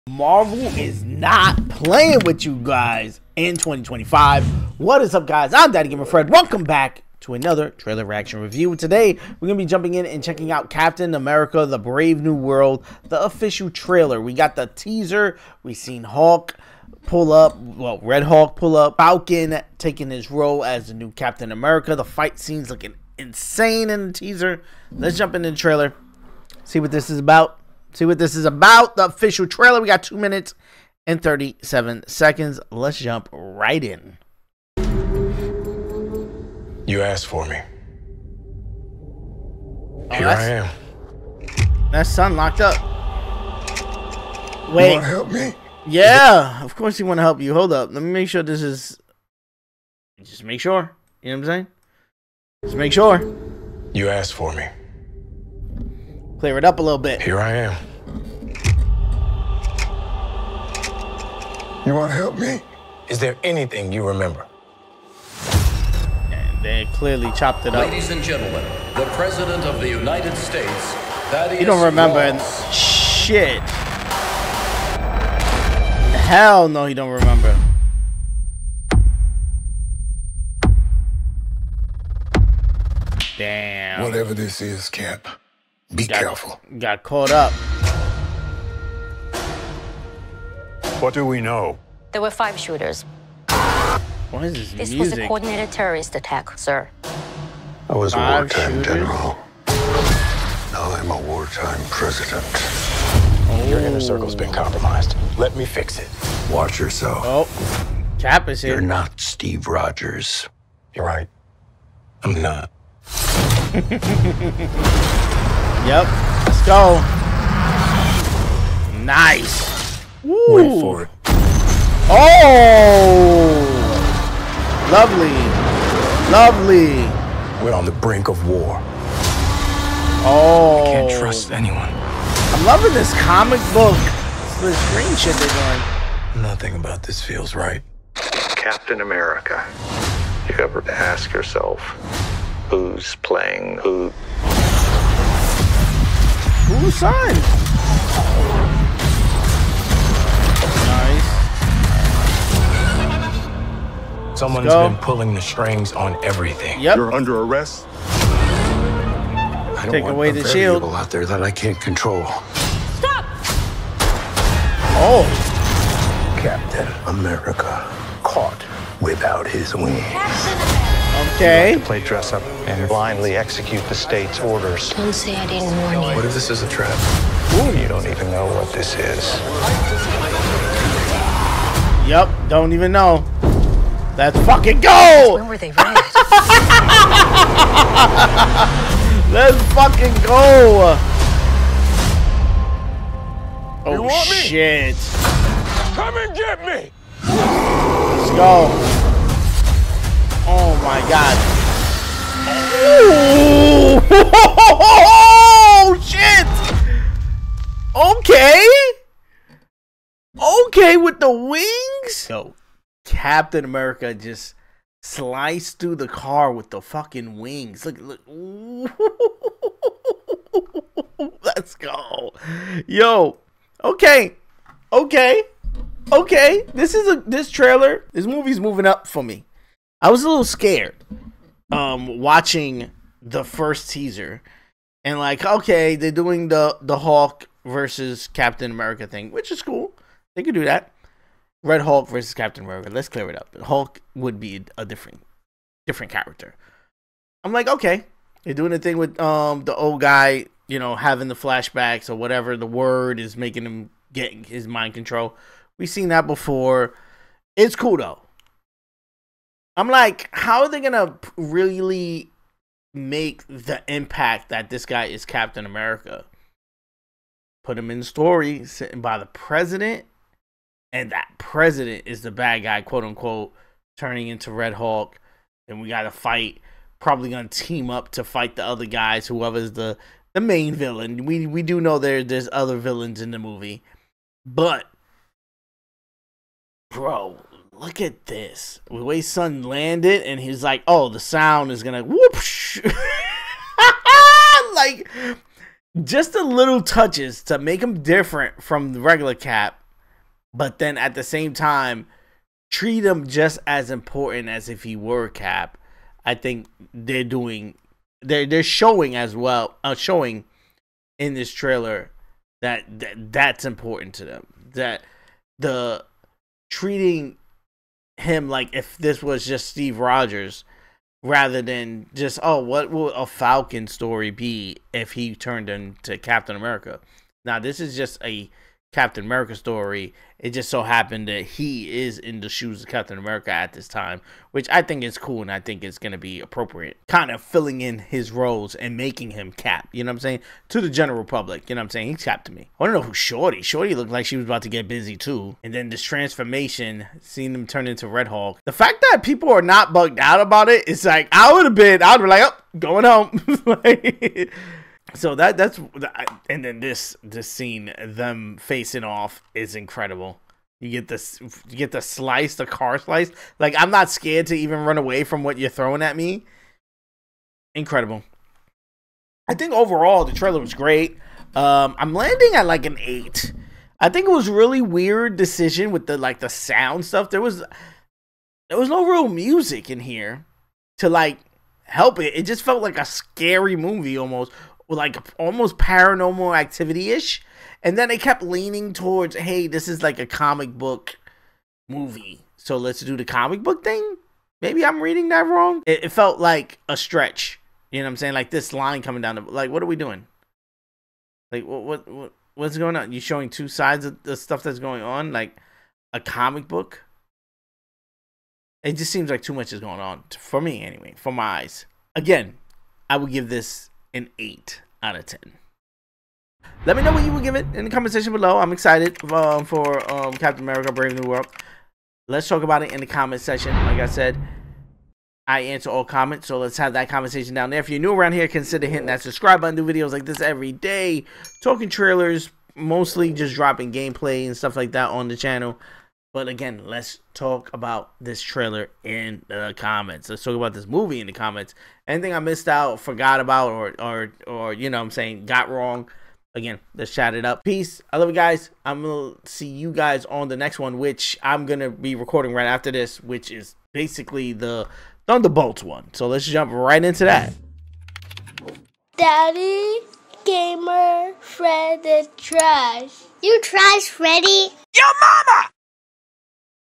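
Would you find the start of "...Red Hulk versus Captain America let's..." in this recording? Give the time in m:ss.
4:01.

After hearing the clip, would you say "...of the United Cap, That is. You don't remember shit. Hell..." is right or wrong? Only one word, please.
wrong.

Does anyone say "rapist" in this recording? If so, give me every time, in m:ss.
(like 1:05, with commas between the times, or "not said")
not said.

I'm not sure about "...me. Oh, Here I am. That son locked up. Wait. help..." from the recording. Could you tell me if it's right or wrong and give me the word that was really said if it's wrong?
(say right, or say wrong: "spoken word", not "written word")
right.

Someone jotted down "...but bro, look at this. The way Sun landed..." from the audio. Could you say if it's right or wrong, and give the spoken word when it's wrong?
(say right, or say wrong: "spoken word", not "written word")
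right.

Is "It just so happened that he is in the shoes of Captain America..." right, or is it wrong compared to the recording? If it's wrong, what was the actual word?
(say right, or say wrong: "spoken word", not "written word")
right.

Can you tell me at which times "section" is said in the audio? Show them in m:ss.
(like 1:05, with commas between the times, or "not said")
6:58, 7:03.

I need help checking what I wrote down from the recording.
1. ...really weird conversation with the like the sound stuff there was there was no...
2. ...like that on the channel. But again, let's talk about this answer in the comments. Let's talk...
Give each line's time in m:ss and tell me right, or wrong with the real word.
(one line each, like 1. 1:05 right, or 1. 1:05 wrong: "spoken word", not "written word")
1. 6:14 wrong: "decision", not "conversation"
2. 7:14 wrong: "trailer", not "answer".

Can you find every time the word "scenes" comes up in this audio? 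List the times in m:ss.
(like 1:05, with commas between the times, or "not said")
0:22, 5:57.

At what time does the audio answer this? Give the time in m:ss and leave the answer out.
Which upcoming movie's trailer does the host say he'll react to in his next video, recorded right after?
7:35.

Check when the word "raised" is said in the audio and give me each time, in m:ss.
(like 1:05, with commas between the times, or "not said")
3:05.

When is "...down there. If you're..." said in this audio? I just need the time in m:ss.
7:07.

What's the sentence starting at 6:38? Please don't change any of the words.
Like this line coming down the like, what are we doing?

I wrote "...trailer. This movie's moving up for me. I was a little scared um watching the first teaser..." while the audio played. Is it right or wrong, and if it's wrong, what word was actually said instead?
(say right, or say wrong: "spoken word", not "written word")
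right.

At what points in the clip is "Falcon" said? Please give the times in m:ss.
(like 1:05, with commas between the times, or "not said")
0:18, 5:23.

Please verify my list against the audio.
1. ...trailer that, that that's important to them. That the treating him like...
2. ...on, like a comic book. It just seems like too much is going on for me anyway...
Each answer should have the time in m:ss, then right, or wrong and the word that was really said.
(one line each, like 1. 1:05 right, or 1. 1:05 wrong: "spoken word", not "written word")
1. 5:11 right
2. 6:45 right.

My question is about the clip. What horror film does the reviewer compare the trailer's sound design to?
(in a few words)
Paranormal Activity.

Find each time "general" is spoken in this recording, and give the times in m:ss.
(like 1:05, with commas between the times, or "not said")
1:38, 5:40.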